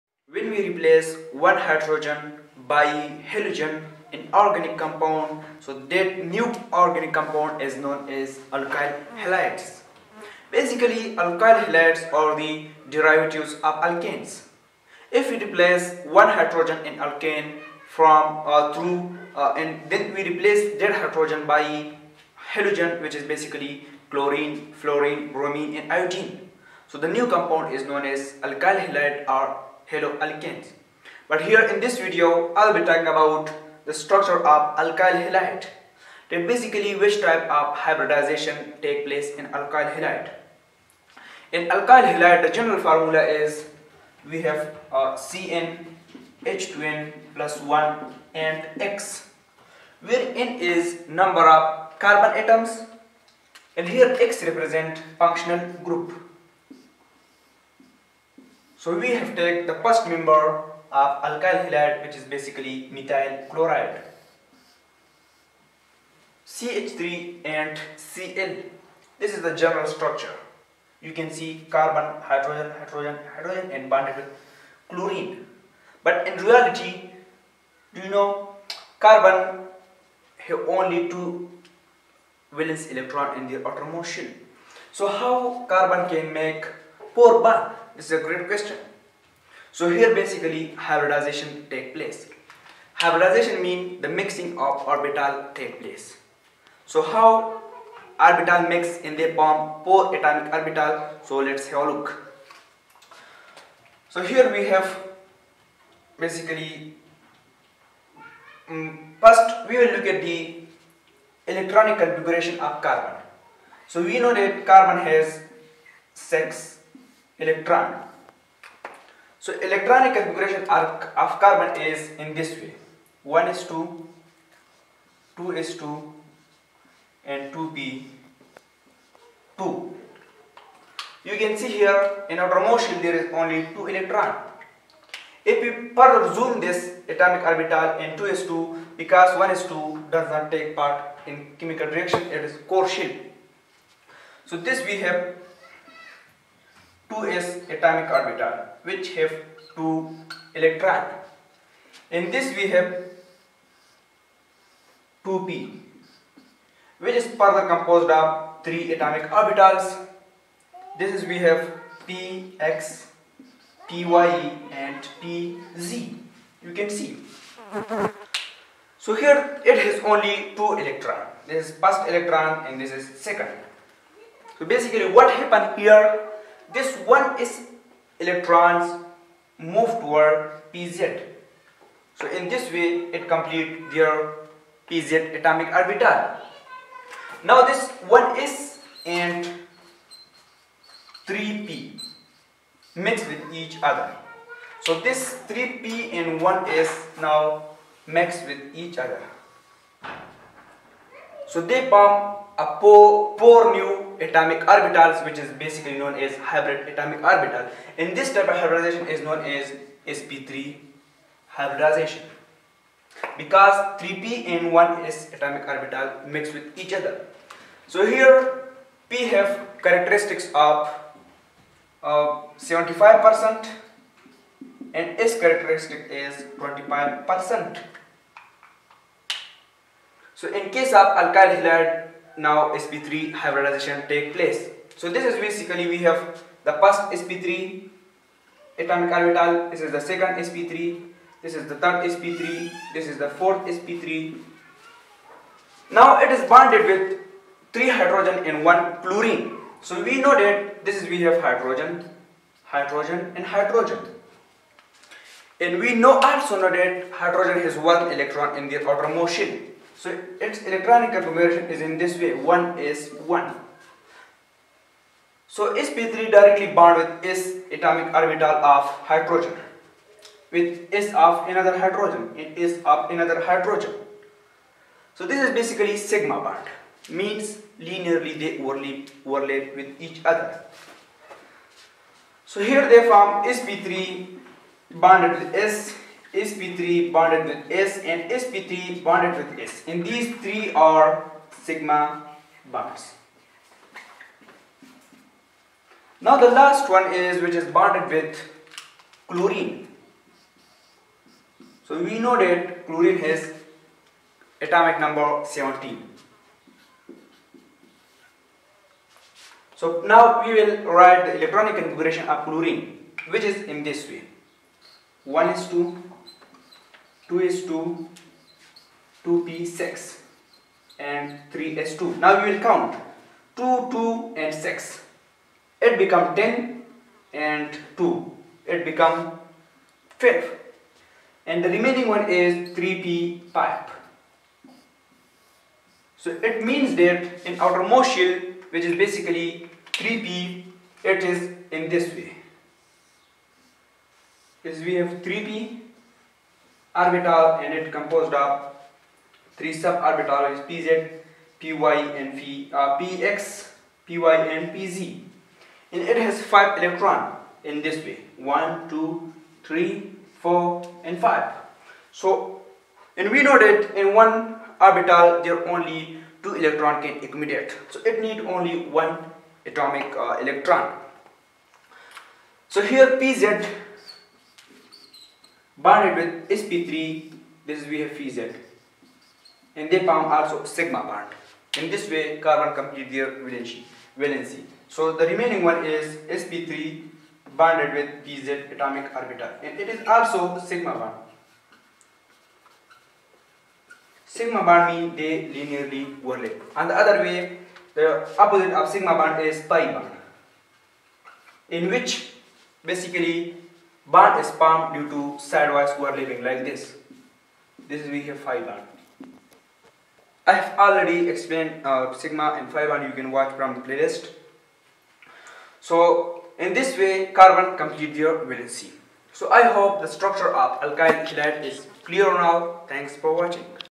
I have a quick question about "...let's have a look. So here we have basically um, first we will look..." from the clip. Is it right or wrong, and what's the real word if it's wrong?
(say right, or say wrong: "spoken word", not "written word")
right.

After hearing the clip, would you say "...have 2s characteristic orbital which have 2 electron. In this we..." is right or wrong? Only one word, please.
wrong.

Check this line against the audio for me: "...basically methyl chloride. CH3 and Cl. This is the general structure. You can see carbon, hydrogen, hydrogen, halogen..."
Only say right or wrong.
wrong.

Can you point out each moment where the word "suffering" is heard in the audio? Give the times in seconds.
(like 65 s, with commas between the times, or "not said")
not said.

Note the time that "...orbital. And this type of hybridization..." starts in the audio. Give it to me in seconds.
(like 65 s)
207 s.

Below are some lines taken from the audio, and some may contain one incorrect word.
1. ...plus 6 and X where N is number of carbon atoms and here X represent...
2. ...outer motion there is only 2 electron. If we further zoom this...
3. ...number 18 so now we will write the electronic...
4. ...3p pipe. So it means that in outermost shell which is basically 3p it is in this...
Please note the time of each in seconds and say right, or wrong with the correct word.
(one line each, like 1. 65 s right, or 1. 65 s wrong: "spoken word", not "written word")
1. 47 s wrong: "1", not "6"
2. 132 s right
3. 305 s wrong: "17", not "18"
4. 332 s right.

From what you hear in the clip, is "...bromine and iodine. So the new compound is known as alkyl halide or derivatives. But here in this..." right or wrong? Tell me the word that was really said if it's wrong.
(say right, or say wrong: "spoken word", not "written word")
wrong: "haloalkanes", not "derivatives".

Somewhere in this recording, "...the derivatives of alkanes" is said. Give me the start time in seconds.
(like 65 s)
12 s.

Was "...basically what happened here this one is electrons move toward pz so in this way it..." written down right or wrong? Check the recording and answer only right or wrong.
right.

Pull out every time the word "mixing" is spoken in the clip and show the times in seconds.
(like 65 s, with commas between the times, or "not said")
94 s.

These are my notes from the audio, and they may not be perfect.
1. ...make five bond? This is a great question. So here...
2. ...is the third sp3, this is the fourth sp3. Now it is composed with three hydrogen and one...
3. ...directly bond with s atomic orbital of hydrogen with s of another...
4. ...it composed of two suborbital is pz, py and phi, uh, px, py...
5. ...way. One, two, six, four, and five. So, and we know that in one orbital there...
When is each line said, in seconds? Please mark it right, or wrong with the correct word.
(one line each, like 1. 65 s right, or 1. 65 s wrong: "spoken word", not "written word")
1. 86 s wrong: "four", not "five"
2. 241 s wrong: "bonded", not "composed"
3. 266 s right
4. 347 s wrong: "three", not "two"
5. 358 s wrong: "three", not "six".